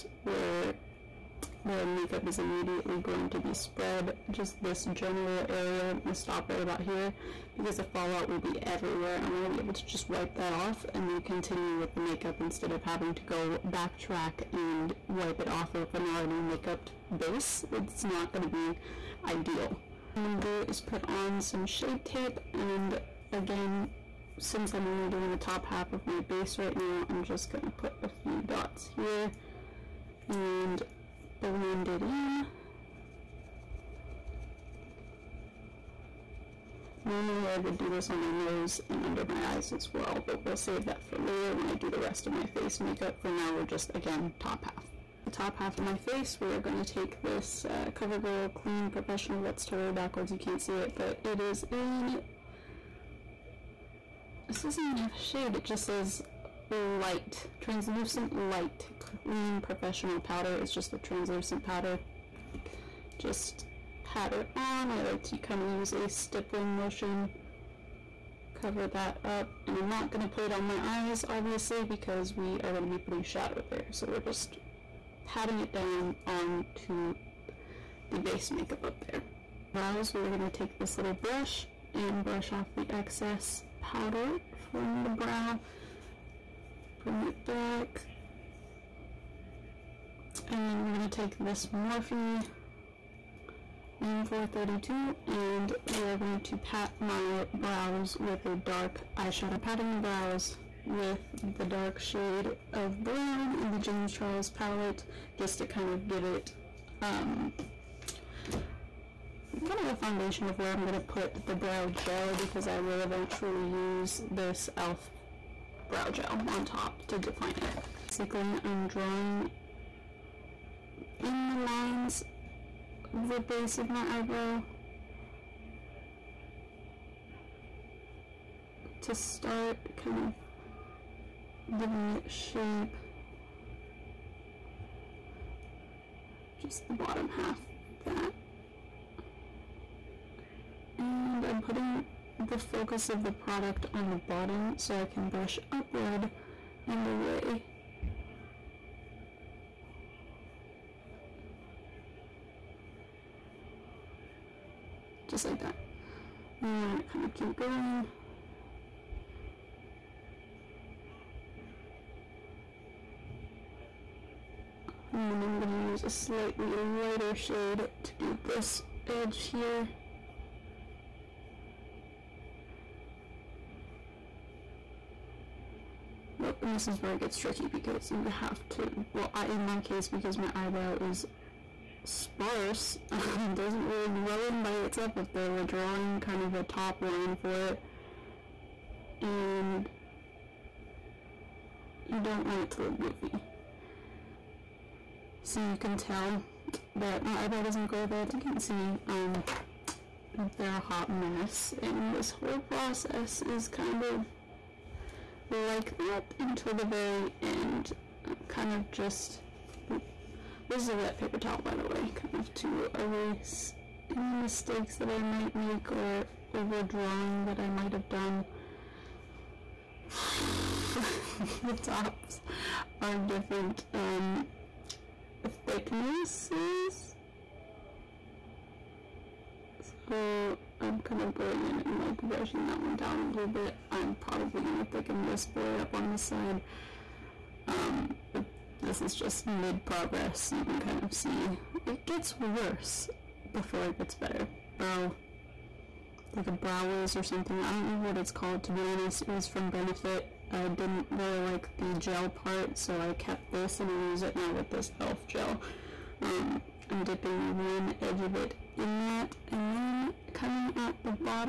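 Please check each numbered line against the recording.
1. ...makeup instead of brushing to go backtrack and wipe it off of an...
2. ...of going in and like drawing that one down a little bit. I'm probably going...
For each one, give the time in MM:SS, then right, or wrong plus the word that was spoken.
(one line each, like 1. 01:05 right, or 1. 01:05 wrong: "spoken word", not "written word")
1. 00:12 wrong: "having", not "brushing"
2. 03:51 wrong: "brushing", not "drawing".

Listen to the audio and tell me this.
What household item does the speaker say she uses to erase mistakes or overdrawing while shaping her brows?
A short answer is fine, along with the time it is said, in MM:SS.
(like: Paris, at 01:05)
wet paper towel, at 03:30.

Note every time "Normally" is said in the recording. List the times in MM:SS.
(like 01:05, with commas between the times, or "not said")
00:37.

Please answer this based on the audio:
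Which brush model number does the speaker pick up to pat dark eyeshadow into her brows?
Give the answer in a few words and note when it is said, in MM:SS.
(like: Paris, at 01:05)
Morphe M432, at 01:31.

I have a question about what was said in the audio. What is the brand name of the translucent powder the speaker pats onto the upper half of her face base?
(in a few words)
CoverGirl Clean Professional.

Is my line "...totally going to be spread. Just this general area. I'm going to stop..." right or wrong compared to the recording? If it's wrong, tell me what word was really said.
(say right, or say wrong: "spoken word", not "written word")
wrong: "immediately", not "totally".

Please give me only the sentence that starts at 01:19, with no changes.
Brows, we are going to take this little brush and brush off the excess powder from the brow.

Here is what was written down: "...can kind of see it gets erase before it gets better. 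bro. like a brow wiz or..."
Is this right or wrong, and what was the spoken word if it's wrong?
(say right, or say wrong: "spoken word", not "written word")
wrong: "worse", not "erase".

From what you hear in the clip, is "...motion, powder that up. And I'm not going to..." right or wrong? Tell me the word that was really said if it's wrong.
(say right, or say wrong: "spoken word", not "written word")
wrong: "cover", not "powder".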